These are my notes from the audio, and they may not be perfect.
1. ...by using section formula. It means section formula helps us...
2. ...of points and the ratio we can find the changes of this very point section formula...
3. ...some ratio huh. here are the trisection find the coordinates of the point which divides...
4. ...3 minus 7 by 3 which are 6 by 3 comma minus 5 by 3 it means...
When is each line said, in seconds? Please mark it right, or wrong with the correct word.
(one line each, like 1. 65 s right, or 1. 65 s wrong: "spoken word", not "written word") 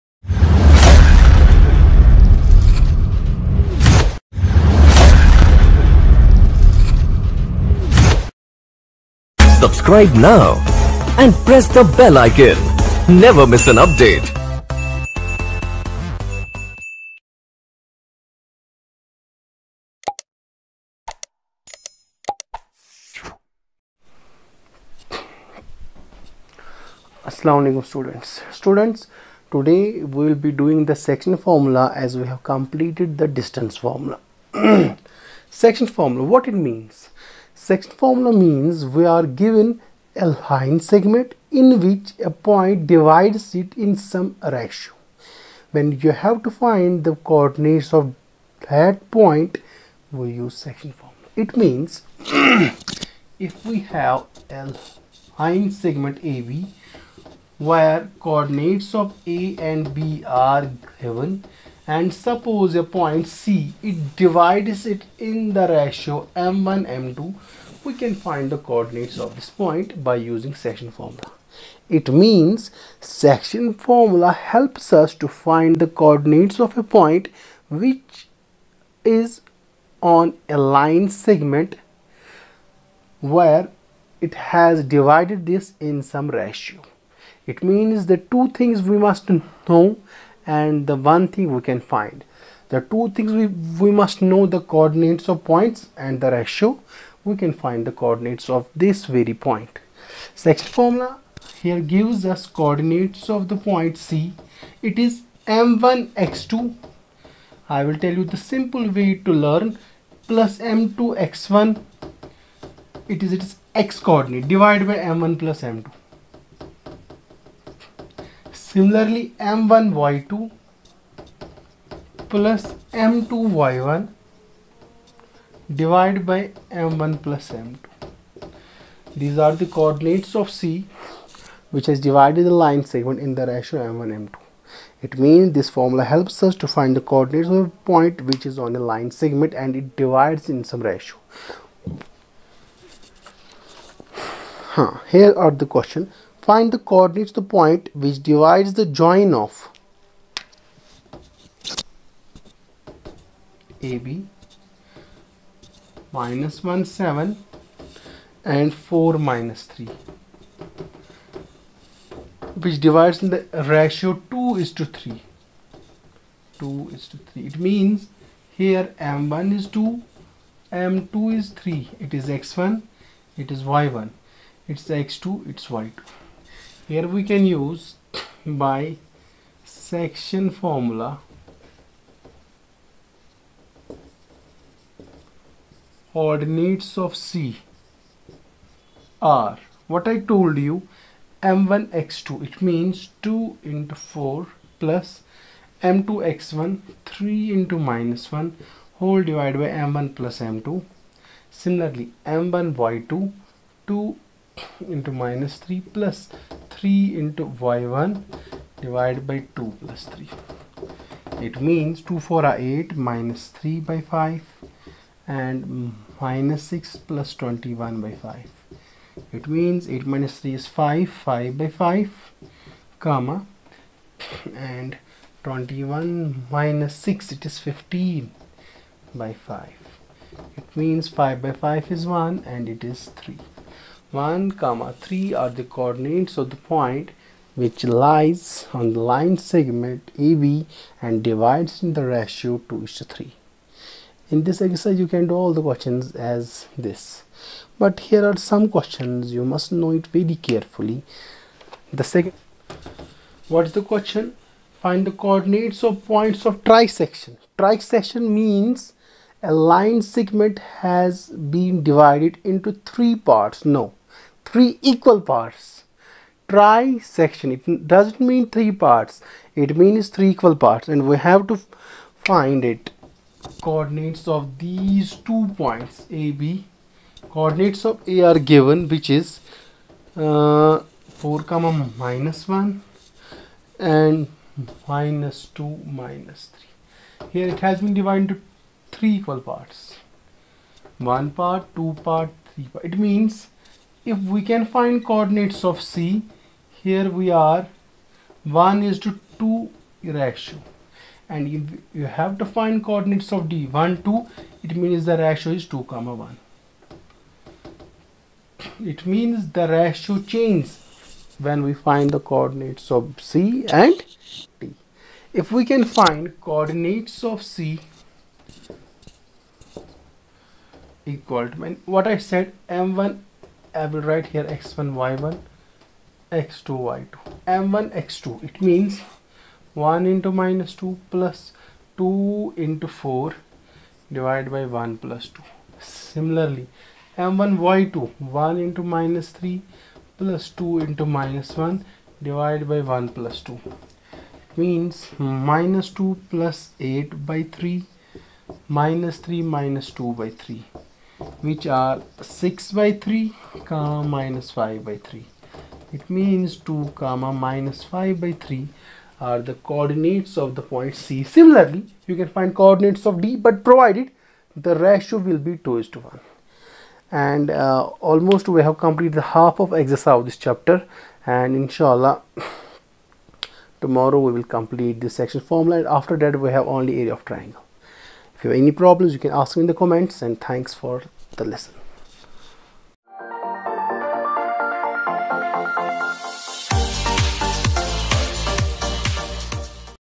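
1. 70 s right
2. 95 s wrong: "coordinates", not "changes"
3. 140 s wrong: "question", not "trisection"
4. 349 s wrong: "2", not "7".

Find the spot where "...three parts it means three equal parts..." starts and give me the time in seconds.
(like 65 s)
268 s.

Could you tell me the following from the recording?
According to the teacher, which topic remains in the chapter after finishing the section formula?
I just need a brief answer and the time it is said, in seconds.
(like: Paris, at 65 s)
area of triangle, at 376 s.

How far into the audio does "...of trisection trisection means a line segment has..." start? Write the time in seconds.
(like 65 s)
256 s.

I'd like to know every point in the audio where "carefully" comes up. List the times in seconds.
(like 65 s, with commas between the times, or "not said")
250 s.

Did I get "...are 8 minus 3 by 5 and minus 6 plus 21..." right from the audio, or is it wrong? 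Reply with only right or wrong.
right.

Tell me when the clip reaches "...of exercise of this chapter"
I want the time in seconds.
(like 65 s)
369 s.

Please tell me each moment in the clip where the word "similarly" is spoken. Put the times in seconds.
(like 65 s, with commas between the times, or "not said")
118 s, 201 s, 335 s, 361 s.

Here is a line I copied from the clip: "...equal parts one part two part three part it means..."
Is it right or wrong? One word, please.
right.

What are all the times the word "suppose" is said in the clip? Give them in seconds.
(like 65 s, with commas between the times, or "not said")
62 s.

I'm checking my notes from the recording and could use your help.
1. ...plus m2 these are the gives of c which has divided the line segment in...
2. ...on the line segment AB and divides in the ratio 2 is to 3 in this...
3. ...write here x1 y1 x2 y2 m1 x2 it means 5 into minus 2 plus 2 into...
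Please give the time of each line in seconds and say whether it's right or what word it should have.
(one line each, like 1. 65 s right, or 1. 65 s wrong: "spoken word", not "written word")
1. 127 s wrong: "coordinates", not "gives"
2. 238 s right
3. 324 s wrong: "1", not "5".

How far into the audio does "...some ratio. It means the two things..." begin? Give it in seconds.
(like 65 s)
86 s.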